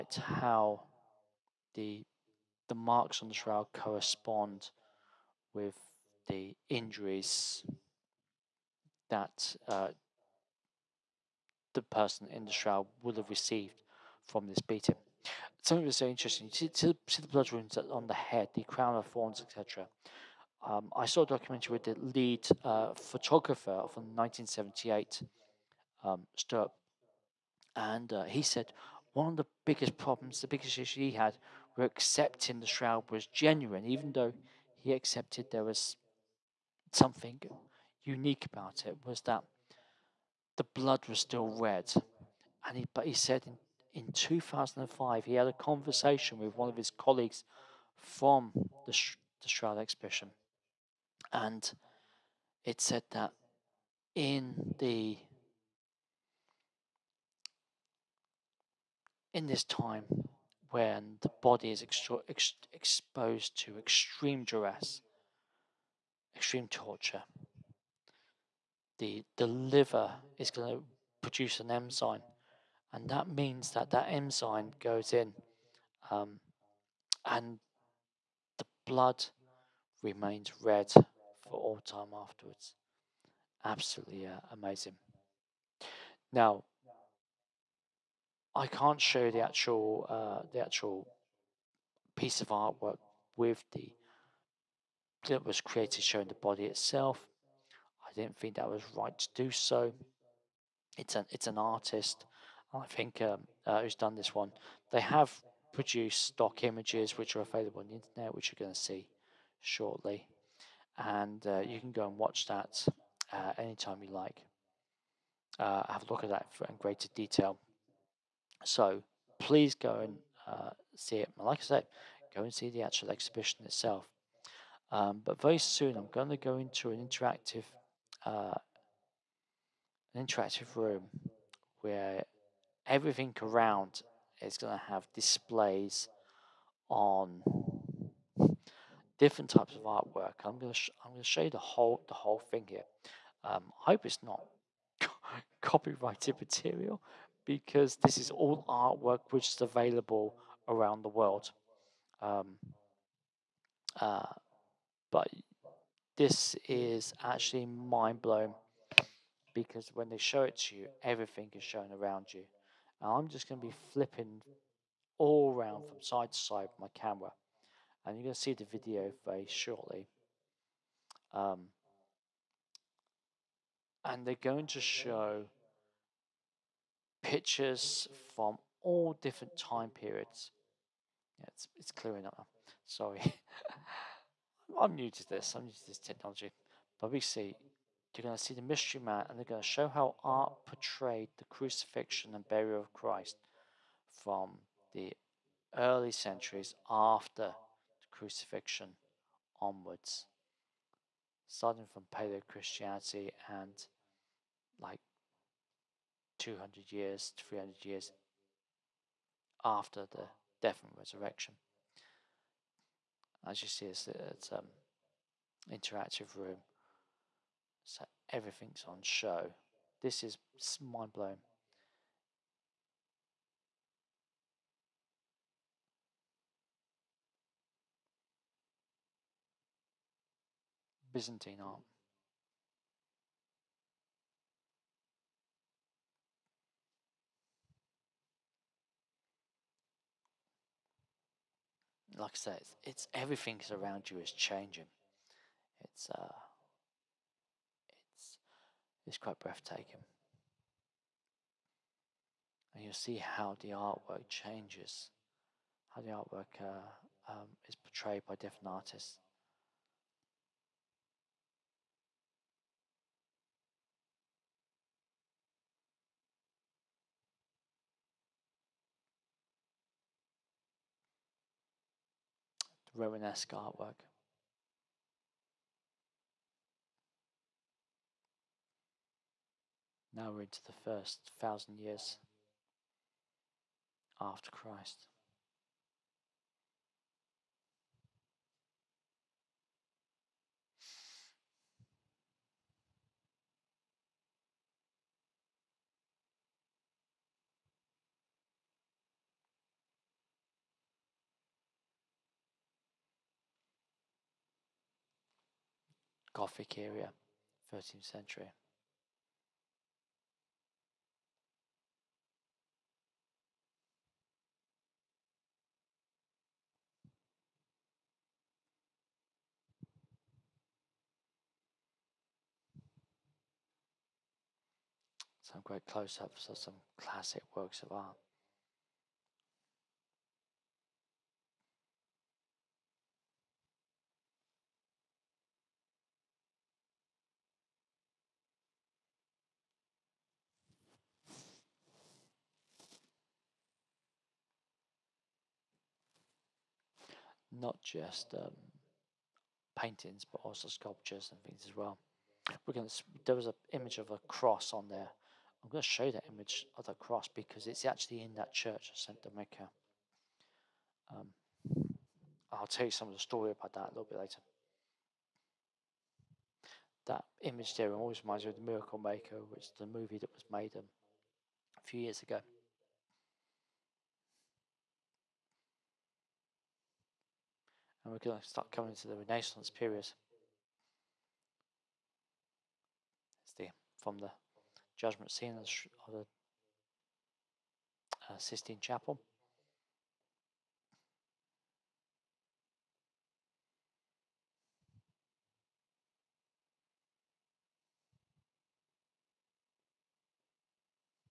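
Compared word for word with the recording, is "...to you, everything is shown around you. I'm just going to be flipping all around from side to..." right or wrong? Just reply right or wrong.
right.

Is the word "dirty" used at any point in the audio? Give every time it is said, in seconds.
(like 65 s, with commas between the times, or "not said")
not said.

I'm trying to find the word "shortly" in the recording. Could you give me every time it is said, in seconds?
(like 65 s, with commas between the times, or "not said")
109 s, 169 s.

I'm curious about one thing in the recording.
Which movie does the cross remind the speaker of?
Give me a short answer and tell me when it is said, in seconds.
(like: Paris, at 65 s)
The Miracle Maker, at 368 s.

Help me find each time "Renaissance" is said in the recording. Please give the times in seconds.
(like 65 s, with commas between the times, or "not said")
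379 s.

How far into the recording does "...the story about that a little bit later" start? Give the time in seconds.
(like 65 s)
363 s.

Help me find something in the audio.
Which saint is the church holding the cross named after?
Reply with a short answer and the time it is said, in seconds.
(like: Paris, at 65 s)
St. Dominica, at 358 s.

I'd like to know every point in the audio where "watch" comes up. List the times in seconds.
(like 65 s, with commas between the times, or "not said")
112 s.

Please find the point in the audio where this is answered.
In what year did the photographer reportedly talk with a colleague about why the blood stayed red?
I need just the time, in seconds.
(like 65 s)
44 s.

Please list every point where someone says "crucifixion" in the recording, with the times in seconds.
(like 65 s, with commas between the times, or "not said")
191 s, 198 s.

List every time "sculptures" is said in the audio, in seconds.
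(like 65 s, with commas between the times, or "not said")
350 s.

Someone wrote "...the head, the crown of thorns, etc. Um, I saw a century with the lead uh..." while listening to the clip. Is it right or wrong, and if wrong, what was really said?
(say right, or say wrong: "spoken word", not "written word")
wrong: "documentary", not "century".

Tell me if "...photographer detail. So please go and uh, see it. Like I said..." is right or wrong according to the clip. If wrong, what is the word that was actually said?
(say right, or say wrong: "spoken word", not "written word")
wrong: "greater", not "photographer".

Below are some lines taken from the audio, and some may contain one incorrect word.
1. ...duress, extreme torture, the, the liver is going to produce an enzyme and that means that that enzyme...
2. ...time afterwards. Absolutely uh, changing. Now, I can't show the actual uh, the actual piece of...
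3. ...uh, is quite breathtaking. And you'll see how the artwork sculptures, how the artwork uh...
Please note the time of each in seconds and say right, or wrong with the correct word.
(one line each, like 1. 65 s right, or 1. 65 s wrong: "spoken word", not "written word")
1. 64 s right
2. 81 s wrong: "amazing", not "changing"
3. 246 s wrong: "changes", not "sculptures".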